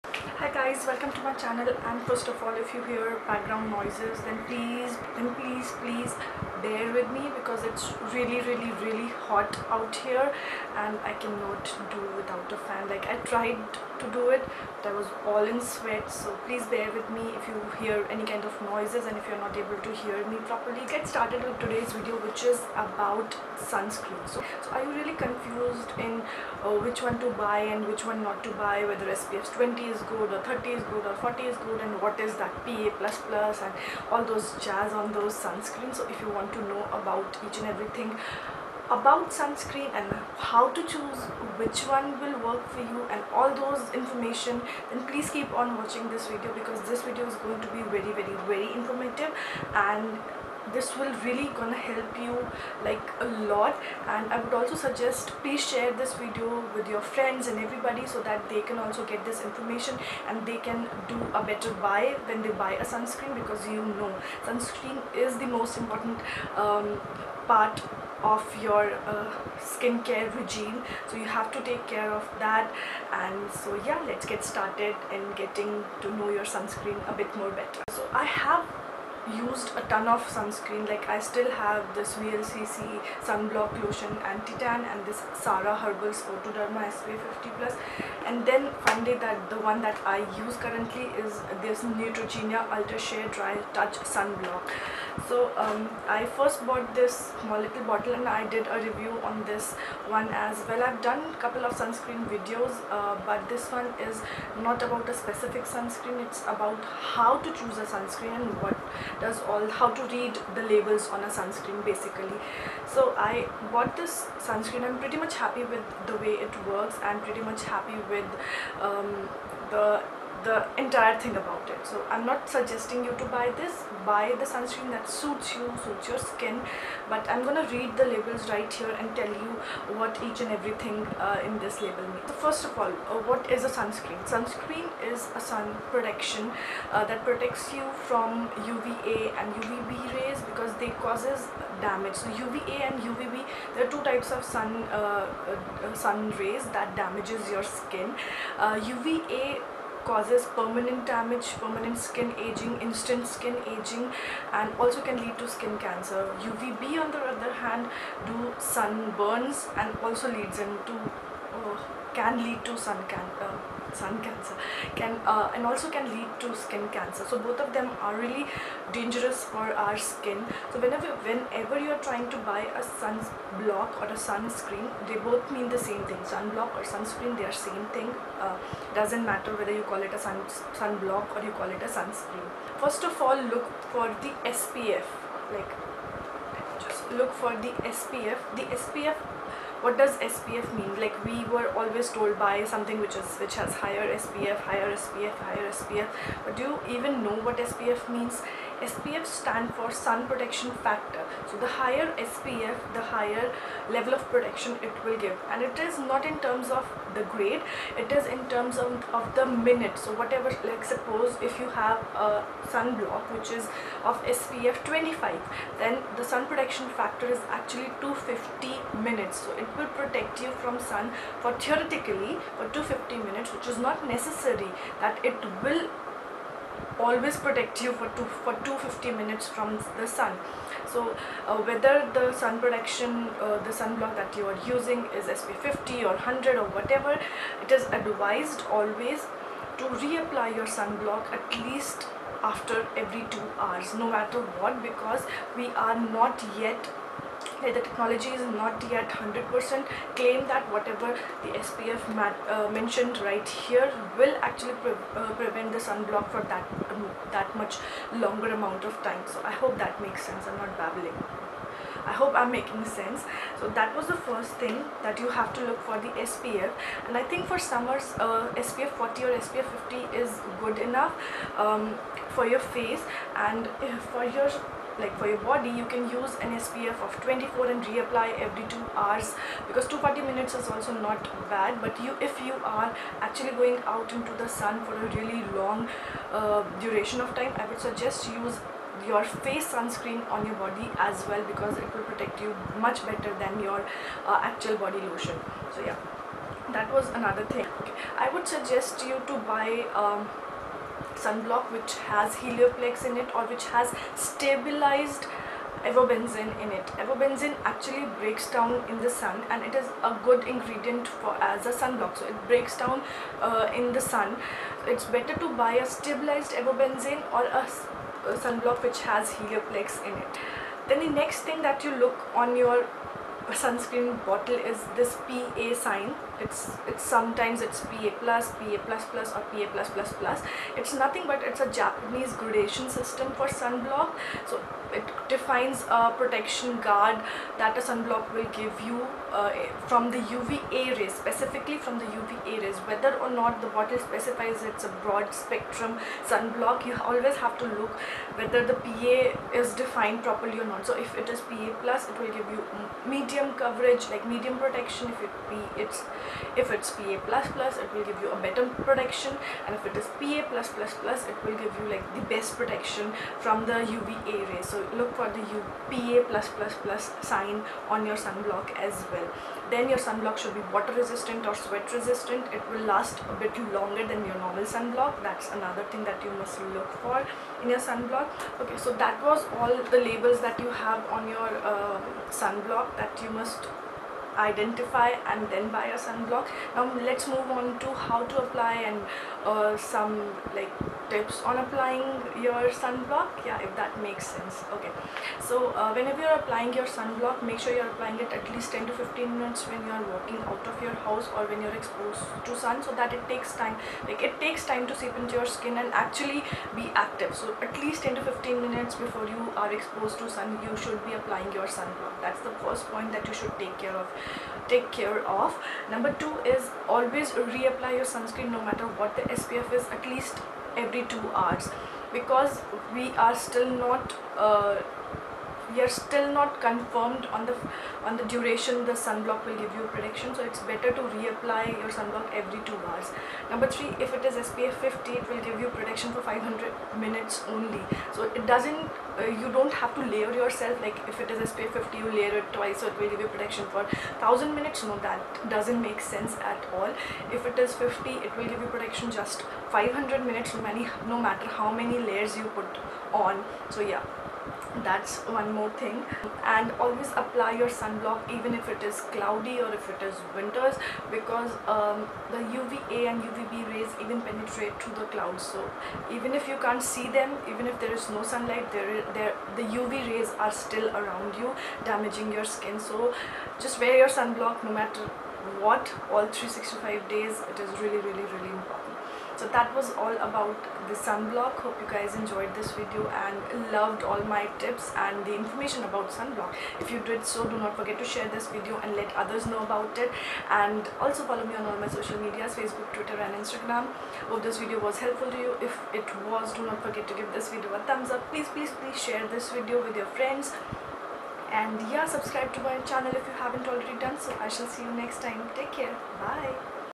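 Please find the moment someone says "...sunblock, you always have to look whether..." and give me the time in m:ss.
5:46.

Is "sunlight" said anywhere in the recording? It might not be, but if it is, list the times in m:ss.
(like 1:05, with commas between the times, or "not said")
7:48.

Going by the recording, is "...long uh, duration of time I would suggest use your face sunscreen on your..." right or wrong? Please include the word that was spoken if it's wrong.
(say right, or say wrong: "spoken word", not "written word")
right.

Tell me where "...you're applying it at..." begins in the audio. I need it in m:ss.
6:37.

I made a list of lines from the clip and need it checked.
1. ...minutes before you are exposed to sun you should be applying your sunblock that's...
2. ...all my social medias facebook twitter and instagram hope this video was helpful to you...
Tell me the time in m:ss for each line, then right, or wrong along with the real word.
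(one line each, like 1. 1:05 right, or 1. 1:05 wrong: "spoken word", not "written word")
1. 6:48 right
2. 8:11 right.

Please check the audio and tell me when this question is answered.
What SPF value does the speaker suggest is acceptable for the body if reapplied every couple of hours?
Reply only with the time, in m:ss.
4:37.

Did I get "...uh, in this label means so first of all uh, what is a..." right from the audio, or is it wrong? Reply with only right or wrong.
right.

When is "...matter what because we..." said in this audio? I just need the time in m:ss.
4:04.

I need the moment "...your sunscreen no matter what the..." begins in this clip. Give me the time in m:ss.
6:57.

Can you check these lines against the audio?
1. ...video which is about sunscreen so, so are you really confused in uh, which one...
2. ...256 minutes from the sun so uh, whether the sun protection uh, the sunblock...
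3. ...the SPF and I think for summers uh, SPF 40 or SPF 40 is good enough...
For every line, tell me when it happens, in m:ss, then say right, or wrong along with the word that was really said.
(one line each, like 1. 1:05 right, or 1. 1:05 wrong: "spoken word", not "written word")
1. 0:21 right
2. 3:48 wrong: "250", not "256"
3. 4:26 wrong: "50", not "40".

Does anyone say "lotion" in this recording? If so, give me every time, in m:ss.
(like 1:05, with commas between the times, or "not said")
1:23, 4:55.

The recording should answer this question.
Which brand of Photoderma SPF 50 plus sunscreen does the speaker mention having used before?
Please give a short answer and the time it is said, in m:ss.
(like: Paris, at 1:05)
Sara Herbals, at 1:25.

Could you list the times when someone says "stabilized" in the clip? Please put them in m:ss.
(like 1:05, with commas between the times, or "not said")
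5:04, 5:15.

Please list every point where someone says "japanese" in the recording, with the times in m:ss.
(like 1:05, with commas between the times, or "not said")
5:31.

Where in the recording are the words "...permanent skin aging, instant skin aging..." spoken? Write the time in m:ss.
2:31.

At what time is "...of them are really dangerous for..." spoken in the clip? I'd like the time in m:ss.
2:47.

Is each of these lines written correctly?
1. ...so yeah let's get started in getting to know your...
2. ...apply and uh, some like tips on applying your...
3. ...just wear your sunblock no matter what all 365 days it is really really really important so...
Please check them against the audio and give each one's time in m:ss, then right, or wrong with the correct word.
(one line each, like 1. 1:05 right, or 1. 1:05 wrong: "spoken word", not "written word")
1. 1:13 right
2. 6:28 right
3. 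7:53 right.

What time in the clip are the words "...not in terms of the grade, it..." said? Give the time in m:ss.
3:25.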